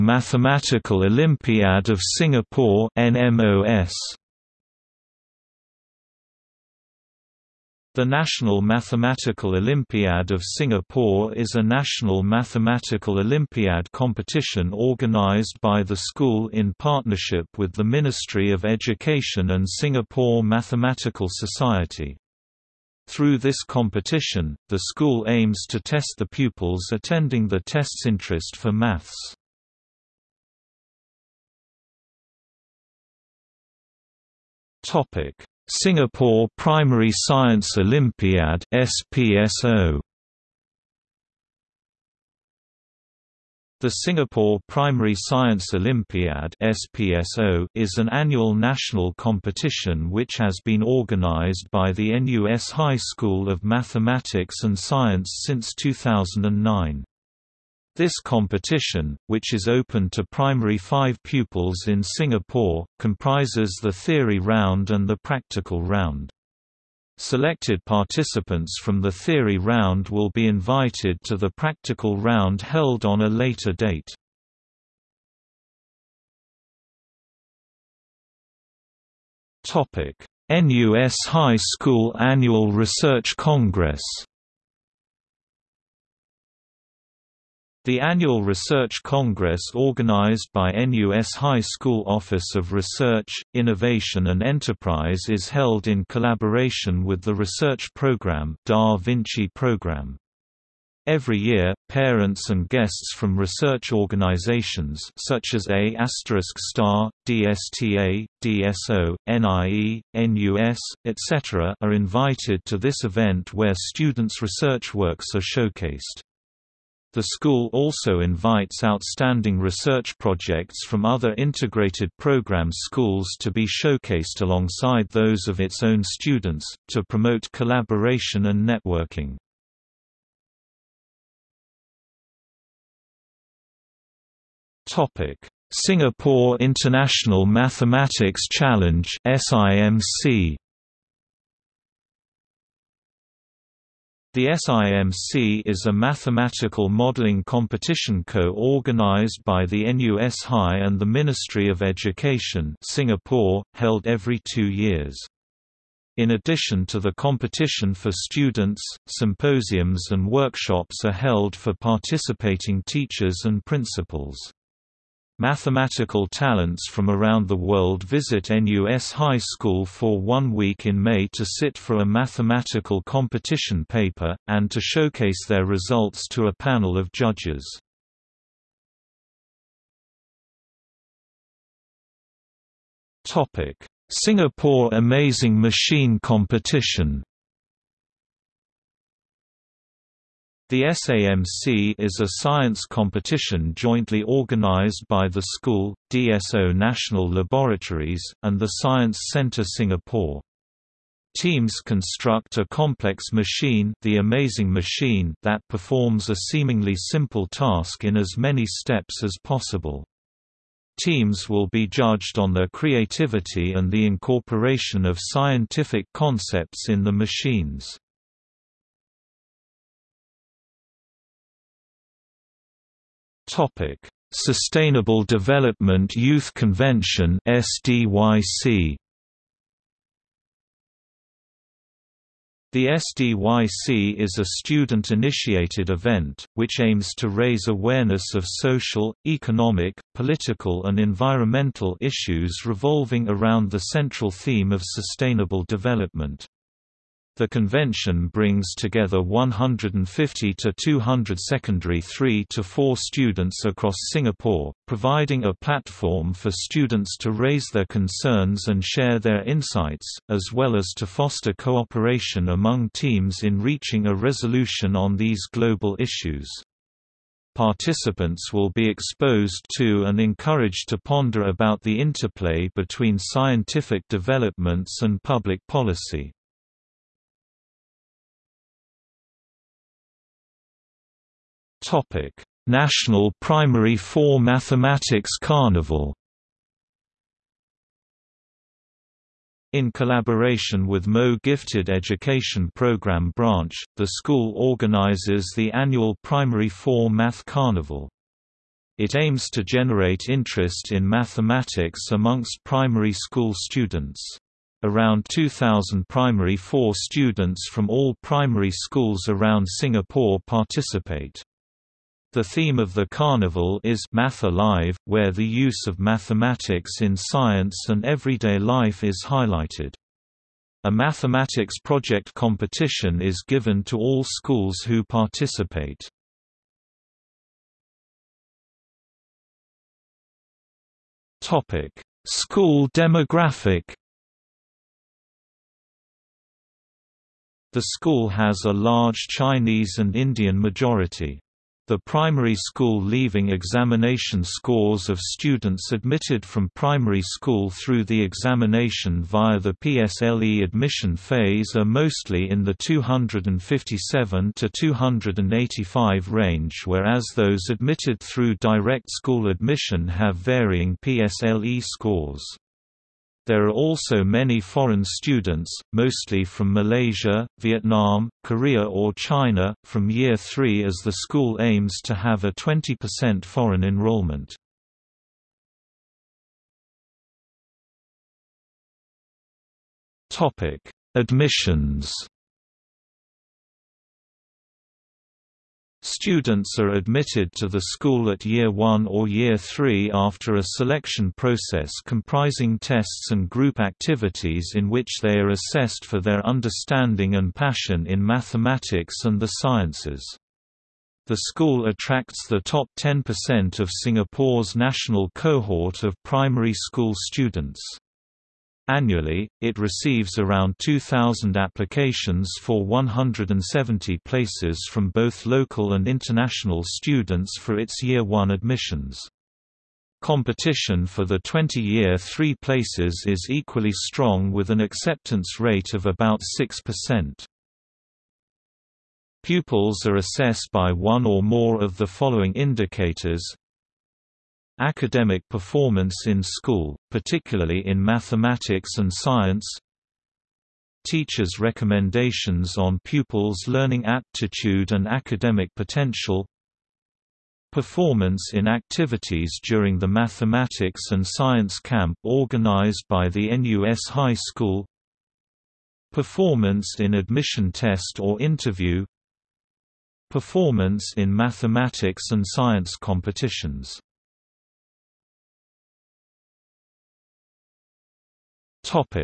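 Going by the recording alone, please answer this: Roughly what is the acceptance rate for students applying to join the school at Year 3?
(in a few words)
6%.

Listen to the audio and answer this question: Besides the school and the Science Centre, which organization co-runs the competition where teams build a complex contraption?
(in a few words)
DSO National Laboratories.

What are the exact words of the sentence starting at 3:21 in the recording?
Teams construct a complex machine, the amazing machine that performs a seemingly simple task in as many steps as possible.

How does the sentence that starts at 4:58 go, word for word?
It aims to generate interest in mathematics amongst primary school students.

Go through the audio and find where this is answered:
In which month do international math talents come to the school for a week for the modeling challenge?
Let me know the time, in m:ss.
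2:51.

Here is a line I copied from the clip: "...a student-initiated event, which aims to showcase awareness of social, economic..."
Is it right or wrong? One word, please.
wrong.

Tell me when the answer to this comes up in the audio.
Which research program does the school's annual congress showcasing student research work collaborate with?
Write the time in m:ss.
1:38.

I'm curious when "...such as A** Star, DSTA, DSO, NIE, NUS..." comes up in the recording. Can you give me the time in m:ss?
1:45.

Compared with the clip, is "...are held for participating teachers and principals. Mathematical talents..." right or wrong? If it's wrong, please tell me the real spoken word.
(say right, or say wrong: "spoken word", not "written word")
right.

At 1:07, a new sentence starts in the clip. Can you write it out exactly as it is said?
Selected participants from the theory round will be invited to the practical round held on a later date.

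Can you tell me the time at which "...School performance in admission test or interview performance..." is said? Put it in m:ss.
7:34.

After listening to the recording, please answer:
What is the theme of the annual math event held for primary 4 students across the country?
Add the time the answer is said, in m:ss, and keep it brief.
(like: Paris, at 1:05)
Math Alive, at 5:14.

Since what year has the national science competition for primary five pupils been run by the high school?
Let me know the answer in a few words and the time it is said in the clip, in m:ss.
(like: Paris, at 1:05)
2009, at 0:55.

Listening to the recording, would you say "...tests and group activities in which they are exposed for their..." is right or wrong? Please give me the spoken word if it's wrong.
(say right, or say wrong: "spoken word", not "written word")
wrong: "assessed", not "exposed".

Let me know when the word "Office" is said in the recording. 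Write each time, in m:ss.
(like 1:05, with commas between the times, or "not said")
1:32.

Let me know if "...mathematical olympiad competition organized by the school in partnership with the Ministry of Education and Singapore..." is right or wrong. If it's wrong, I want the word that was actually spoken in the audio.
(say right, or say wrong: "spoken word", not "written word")
right.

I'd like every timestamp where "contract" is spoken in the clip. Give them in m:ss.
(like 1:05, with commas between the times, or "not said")
not said.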